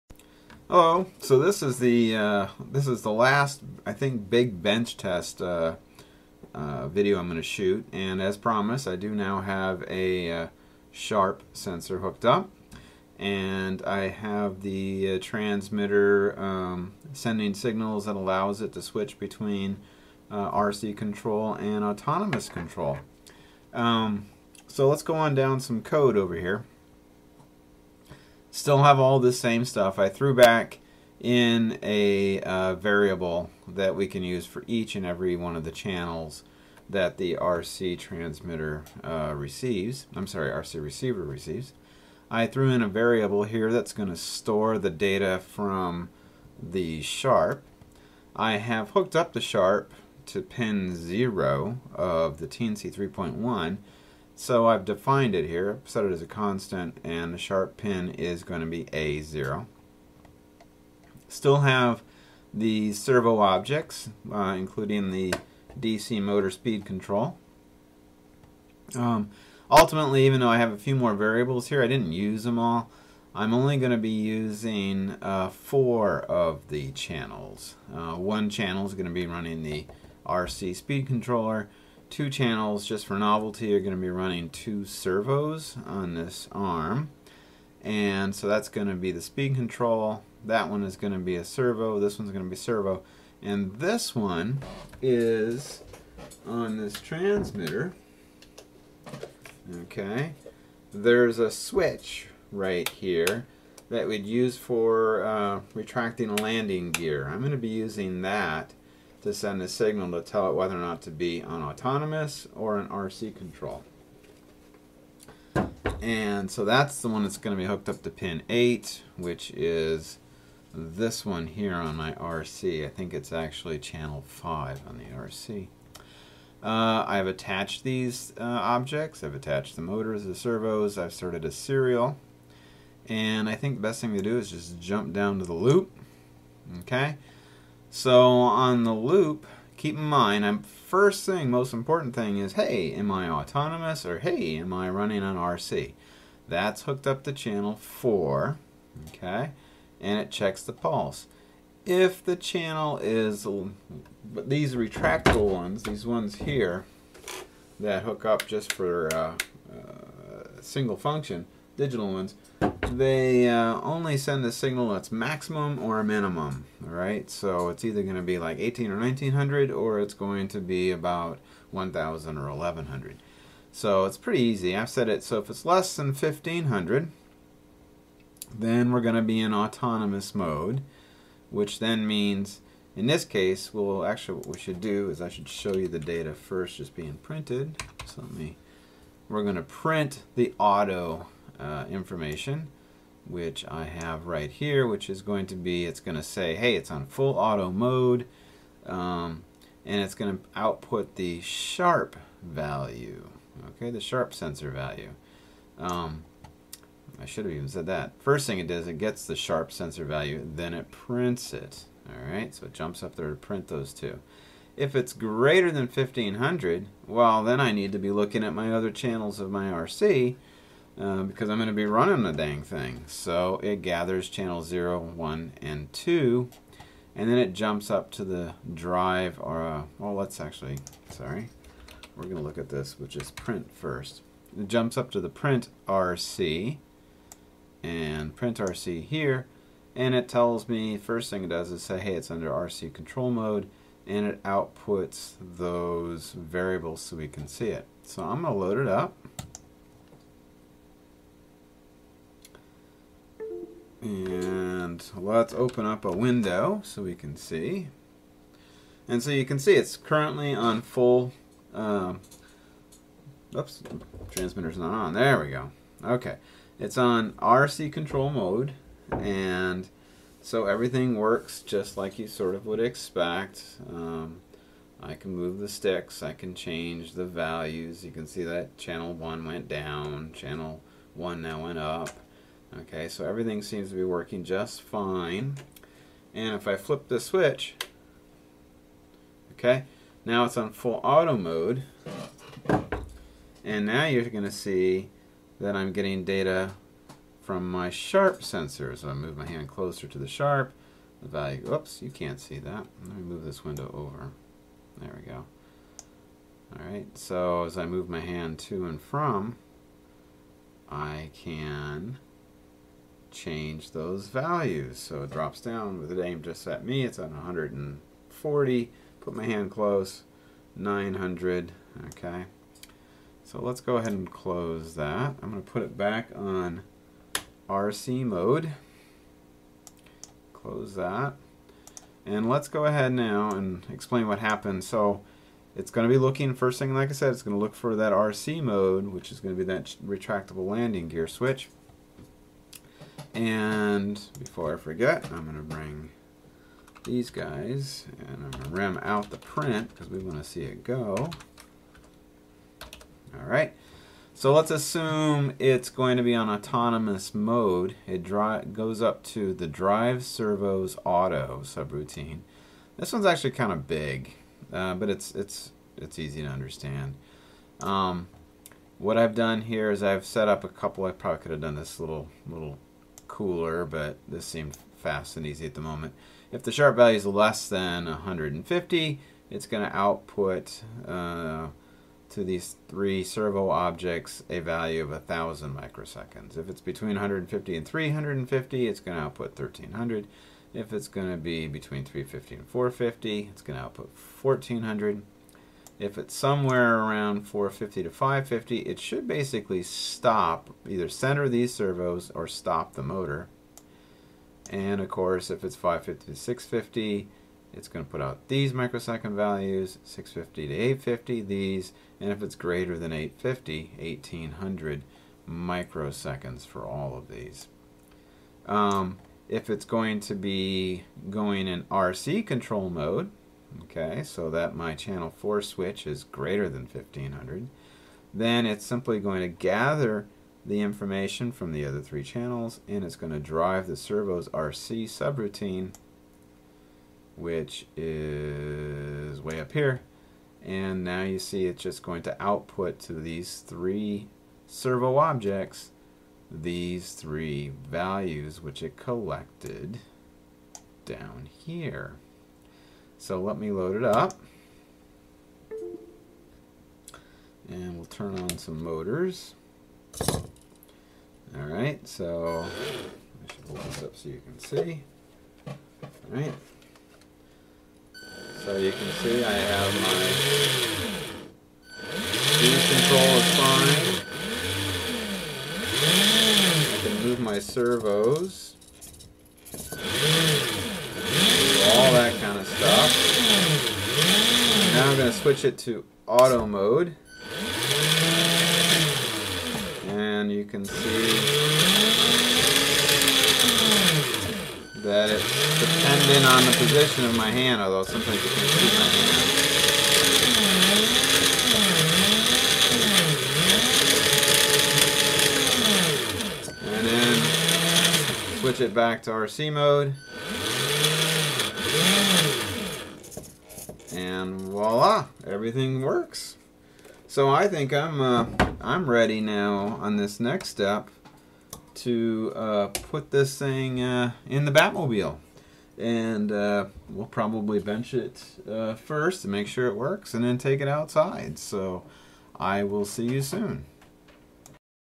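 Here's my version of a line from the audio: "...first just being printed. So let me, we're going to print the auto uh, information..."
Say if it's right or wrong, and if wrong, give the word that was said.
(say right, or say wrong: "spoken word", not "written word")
right.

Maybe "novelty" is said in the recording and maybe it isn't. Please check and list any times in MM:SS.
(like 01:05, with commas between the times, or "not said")
01:23.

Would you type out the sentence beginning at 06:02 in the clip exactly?
This one's actually kind of big, uh, but it's it's it's easy to understand.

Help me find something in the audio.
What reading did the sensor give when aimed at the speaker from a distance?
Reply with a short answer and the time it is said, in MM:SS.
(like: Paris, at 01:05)
140, at 05:17.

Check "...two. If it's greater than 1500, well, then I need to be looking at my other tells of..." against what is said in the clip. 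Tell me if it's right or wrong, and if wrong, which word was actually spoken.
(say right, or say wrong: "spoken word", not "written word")
wrong: "channels", not "tells".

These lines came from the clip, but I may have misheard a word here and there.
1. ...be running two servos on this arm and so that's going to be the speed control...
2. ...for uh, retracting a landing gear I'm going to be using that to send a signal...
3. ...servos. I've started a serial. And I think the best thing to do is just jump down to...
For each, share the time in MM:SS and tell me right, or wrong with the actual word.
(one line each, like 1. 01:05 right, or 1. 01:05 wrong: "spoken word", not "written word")
1. 01:24 right
2. 01:44 right
3. 02:10 right.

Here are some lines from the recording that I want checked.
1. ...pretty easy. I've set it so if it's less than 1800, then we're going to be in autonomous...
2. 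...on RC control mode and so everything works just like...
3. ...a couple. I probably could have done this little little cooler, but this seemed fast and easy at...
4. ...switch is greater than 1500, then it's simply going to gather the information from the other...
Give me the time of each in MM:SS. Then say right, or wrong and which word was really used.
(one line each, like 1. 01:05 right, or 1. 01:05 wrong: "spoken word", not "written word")
1. 02:54 wrong: "1500", not "1800"
2. 04:26 right
3. 06:10 right
4. 07:05 right.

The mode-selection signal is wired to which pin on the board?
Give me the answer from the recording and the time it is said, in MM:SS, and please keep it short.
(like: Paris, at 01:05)
8, at 01:58.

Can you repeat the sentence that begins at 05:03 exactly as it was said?
Let me move this window over.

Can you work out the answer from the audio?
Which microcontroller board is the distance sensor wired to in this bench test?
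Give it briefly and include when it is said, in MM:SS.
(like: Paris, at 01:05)
Teensy 3.1, at 00:52.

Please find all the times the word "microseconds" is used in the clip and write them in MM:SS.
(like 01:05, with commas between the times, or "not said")
06:25, 06:48, 06:55.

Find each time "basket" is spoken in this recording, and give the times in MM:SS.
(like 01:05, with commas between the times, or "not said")
not said.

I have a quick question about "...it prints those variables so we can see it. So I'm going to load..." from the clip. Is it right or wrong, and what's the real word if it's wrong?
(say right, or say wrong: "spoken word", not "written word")
wrong: "outputs", not "prints".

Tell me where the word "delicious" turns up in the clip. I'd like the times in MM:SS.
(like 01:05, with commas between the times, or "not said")
not said.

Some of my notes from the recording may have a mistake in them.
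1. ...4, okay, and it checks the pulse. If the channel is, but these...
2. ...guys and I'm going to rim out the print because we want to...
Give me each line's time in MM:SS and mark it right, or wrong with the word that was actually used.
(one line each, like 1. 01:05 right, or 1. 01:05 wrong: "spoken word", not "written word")
1. 02:27 right
2. 05:47 right.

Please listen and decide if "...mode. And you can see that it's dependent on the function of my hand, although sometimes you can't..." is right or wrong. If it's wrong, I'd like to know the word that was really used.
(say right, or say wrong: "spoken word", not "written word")
wrong: "position", not "function".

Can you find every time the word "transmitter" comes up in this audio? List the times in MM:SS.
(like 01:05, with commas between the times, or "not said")
00:15, 00:37, 01:36, 04:24.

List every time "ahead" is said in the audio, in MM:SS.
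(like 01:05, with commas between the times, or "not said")
05:23, 05:32.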